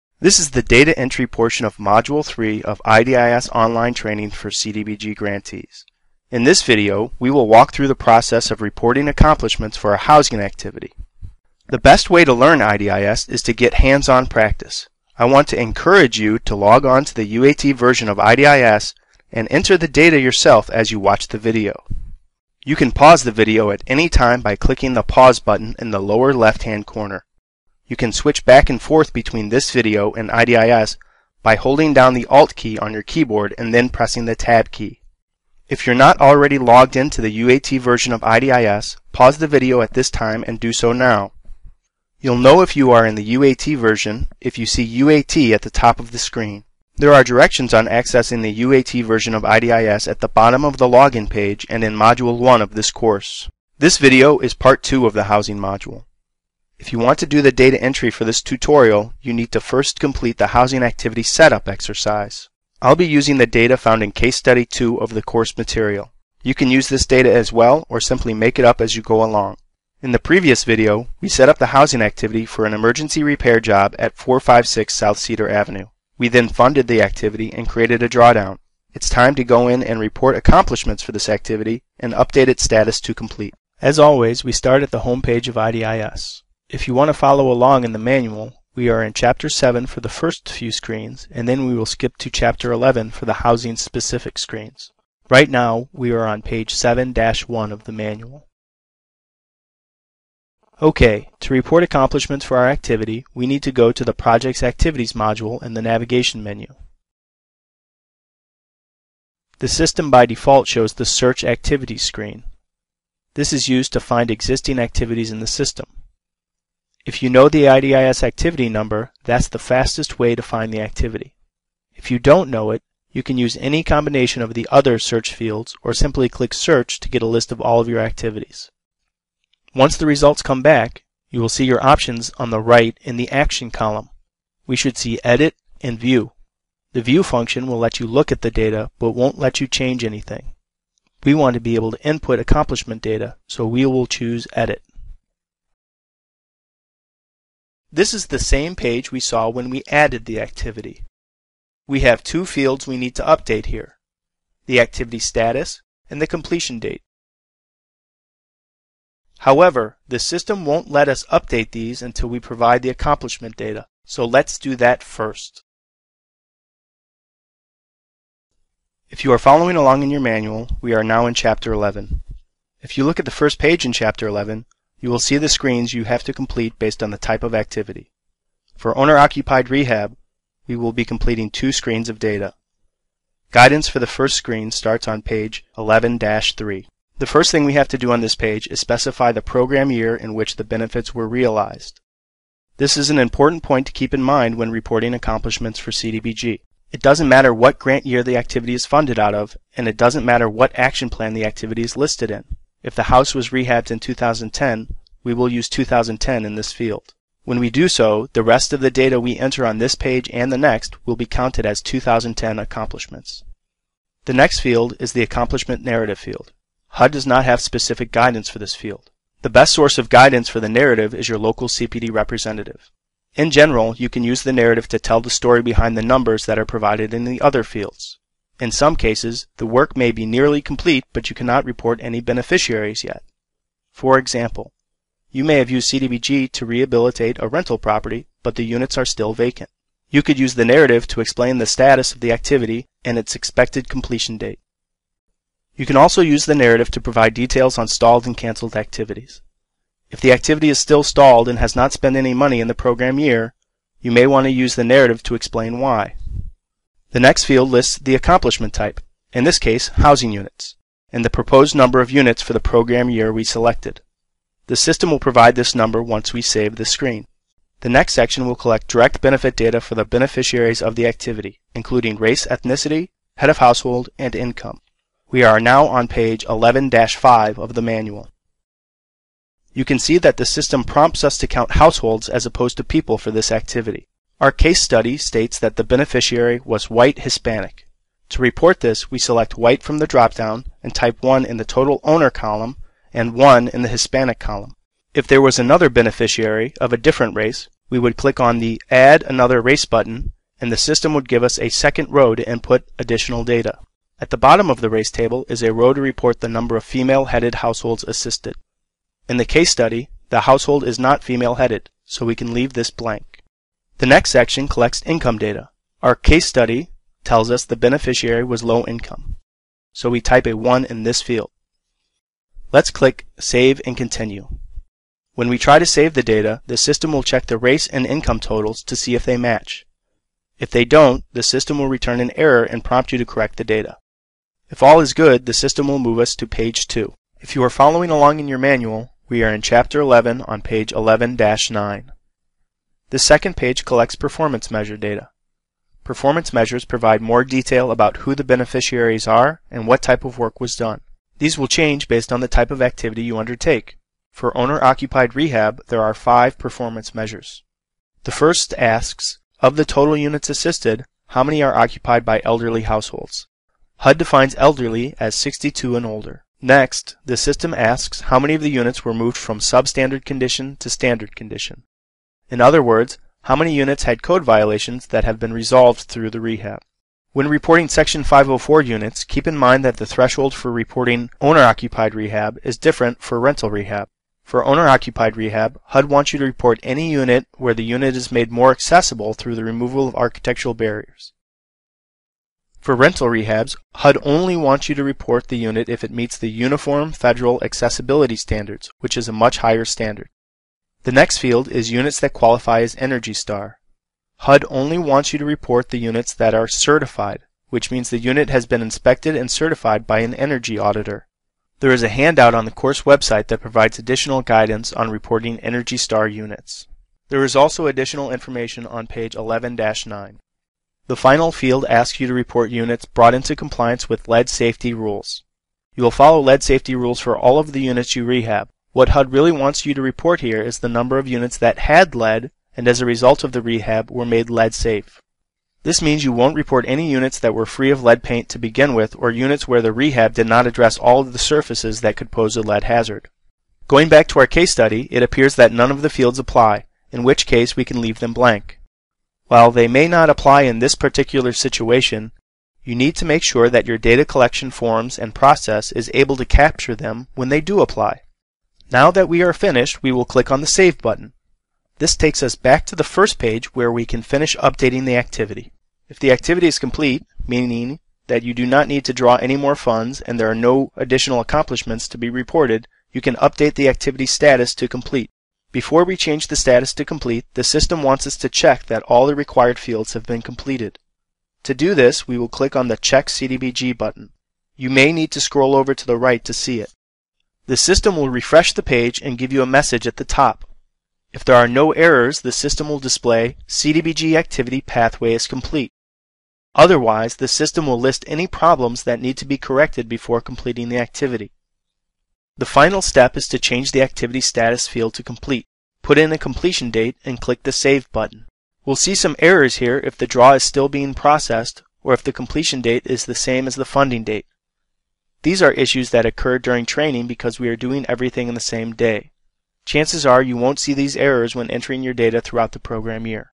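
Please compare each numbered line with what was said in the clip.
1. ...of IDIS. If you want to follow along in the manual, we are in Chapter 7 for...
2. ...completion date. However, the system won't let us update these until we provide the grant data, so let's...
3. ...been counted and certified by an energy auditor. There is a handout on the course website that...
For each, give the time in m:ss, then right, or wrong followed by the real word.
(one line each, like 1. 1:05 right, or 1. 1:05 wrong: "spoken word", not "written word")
1. 1:25 right
2. 2:36 wrong: "accomplishment", not "grant"
3. 6:48 wrong: "inspected", not "counted".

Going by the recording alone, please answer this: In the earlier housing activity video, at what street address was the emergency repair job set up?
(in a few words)
456 South Cedar Avenue.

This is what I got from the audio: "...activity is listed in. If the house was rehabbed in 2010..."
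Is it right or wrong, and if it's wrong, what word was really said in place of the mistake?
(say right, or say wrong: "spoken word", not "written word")
right.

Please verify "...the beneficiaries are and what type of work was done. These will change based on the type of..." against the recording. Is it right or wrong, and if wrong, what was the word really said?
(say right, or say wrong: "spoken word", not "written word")
right.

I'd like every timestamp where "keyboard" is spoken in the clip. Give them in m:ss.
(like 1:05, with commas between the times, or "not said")
0:33.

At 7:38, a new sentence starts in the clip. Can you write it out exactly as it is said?
Now that we are finished, we will click on the Save button.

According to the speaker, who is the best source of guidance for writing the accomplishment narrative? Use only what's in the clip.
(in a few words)
Local CPD representative.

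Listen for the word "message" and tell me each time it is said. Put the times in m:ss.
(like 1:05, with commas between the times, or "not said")
8:09.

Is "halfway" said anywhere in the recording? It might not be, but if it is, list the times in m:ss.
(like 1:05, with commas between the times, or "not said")
not said.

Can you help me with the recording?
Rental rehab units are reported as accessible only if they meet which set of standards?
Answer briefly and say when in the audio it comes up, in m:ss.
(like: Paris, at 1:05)
Uniform Federal Accessibility Standards, at 6:36.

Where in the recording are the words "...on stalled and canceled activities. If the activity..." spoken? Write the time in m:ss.
4:07.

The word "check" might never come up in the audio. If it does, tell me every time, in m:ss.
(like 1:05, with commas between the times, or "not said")
5:27, 7:58, 8:02.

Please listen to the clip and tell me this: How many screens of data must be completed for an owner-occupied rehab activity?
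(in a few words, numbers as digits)
2.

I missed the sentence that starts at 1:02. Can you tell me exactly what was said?
I'll be using the data found in Case Study 2 of the course material.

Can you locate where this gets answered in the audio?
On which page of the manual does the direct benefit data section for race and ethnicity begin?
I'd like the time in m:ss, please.
4:36.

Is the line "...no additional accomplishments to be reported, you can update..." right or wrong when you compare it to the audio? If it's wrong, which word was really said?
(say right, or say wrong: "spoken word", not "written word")
right.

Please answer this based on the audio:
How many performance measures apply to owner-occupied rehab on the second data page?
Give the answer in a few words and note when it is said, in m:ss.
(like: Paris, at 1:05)
5, at 5:56.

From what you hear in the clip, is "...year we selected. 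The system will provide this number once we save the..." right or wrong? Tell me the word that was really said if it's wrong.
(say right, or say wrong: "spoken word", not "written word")
right.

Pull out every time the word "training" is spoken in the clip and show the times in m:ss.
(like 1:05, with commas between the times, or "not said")
0:03, 8:36.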